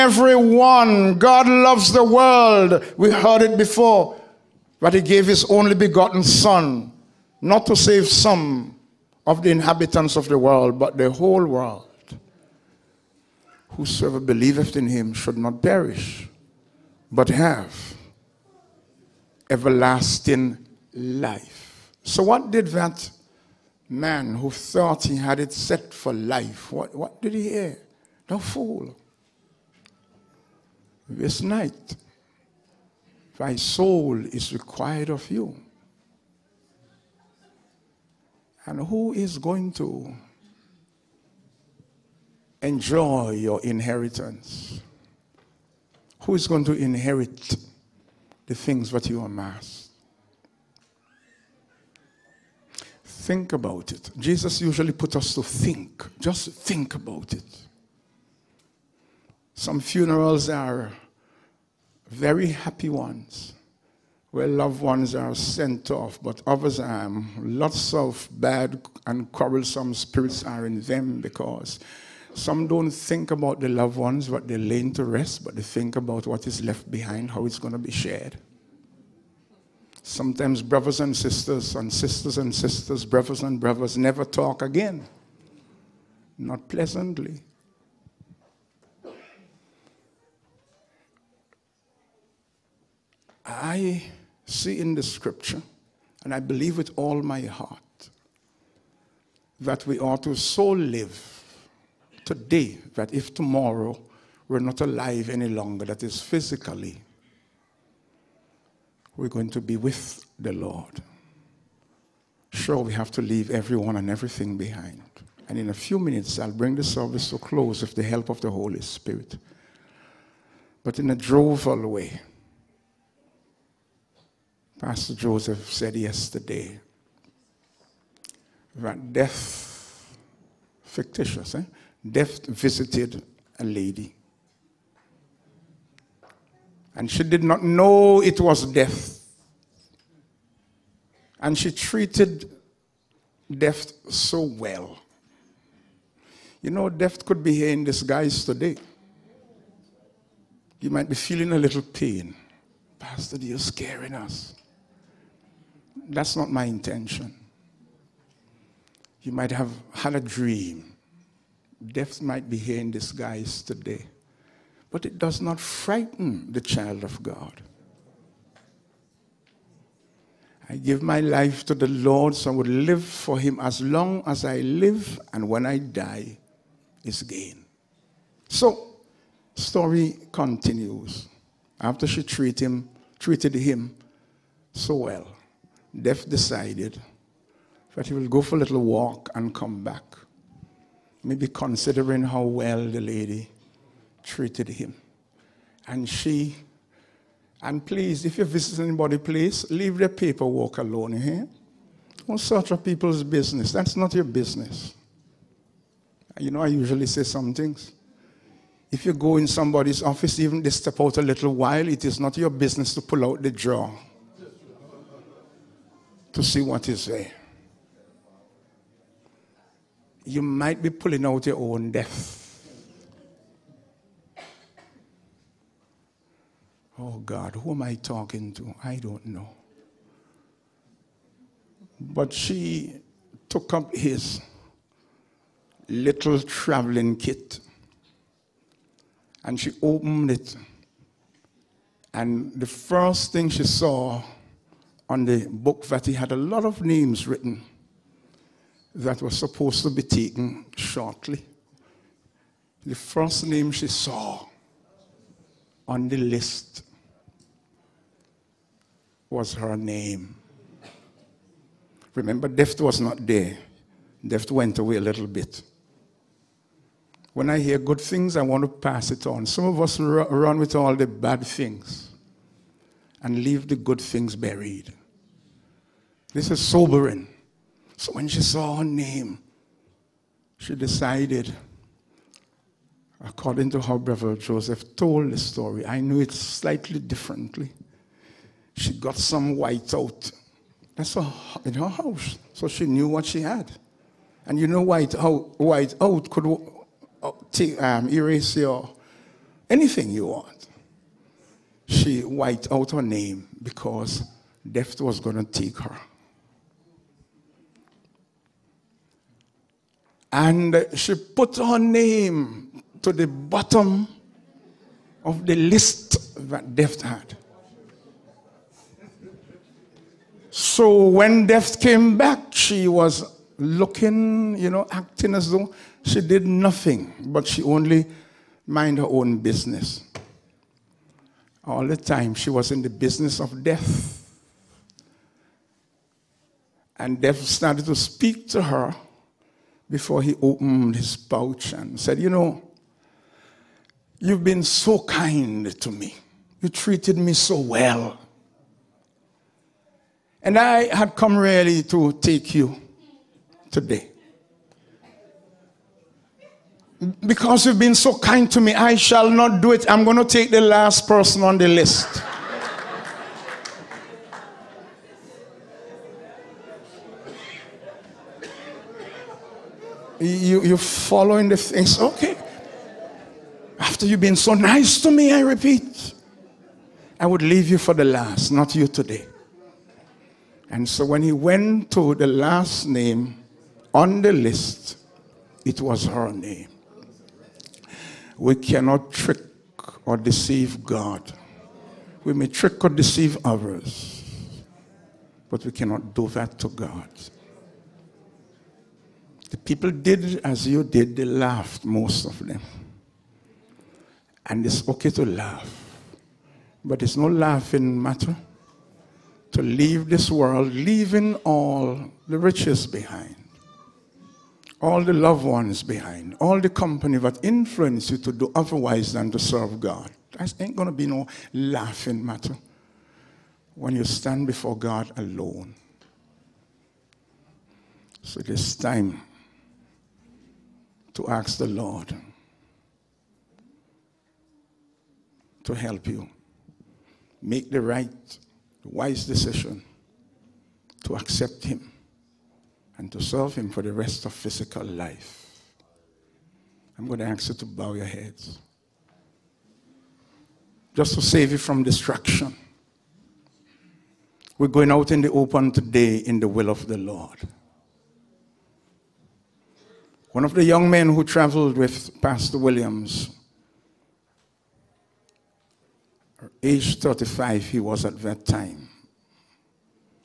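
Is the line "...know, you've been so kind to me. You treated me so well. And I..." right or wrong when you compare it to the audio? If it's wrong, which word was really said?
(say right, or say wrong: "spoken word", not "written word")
right.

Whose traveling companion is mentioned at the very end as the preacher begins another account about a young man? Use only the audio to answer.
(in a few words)
Pastor Williams.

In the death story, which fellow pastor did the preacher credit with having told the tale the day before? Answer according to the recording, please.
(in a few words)
Pastor Joseph.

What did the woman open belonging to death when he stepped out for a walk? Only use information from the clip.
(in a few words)
His little traveling kit.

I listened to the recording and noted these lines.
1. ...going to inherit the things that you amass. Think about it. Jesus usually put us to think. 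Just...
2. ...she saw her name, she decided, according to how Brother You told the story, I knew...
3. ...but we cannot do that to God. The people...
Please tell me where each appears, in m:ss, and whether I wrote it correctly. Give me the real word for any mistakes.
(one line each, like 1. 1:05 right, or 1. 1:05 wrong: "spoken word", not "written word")
1. 0:46 right
2. 4:38 wrong: "Joseph", not "You"
3. 6:35 right.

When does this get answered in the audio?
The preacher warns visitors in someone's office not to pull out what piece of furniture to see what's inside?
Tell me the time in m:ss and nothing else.
3:33.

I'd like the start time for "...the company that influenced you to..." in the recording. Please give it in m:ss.
6:56.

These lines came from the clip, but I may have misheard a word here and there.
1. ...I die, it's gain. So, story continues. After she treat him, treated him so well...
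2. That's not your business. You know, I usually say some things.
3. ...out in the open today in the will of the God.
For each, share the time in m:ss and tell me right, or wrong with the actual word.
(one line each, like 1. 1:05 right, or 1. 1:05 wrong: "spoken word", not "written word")
1. 2:55 right
2. 3:23 right
3. 7:34 wrong: "Lord", not "God".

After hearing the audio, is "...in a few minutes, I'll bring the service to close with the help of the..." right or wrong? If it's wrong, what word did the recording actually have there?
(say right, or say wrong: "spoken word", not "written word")
right.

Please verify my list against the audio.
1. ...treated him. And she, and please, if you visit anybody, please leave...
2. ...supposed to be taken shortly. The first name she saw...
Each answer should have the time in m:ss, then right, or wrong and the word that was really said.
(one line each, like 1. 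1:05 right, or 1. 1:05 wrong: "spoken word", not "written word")
1. 3:14 right
2. 4:09 right.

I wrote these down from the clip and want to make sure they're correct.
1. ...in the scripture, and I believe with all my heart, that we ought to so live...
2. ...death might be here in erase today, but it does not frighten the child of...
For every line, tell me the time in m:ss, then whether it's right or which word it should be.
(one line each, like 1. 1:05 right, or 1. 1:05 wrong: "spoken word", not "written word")
1. 1:34 right
2. 2:41 wrong: "disguise", not "erase".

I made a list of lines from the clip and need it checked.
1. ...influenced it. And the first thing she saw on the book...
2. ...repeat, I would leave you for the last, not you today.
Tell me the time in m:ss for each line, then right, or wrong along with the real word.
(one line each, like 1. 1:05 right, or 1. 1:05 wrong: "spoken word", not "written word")
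1. 3:59 wrong: "opened", not "influenced"
2. 6:15 right.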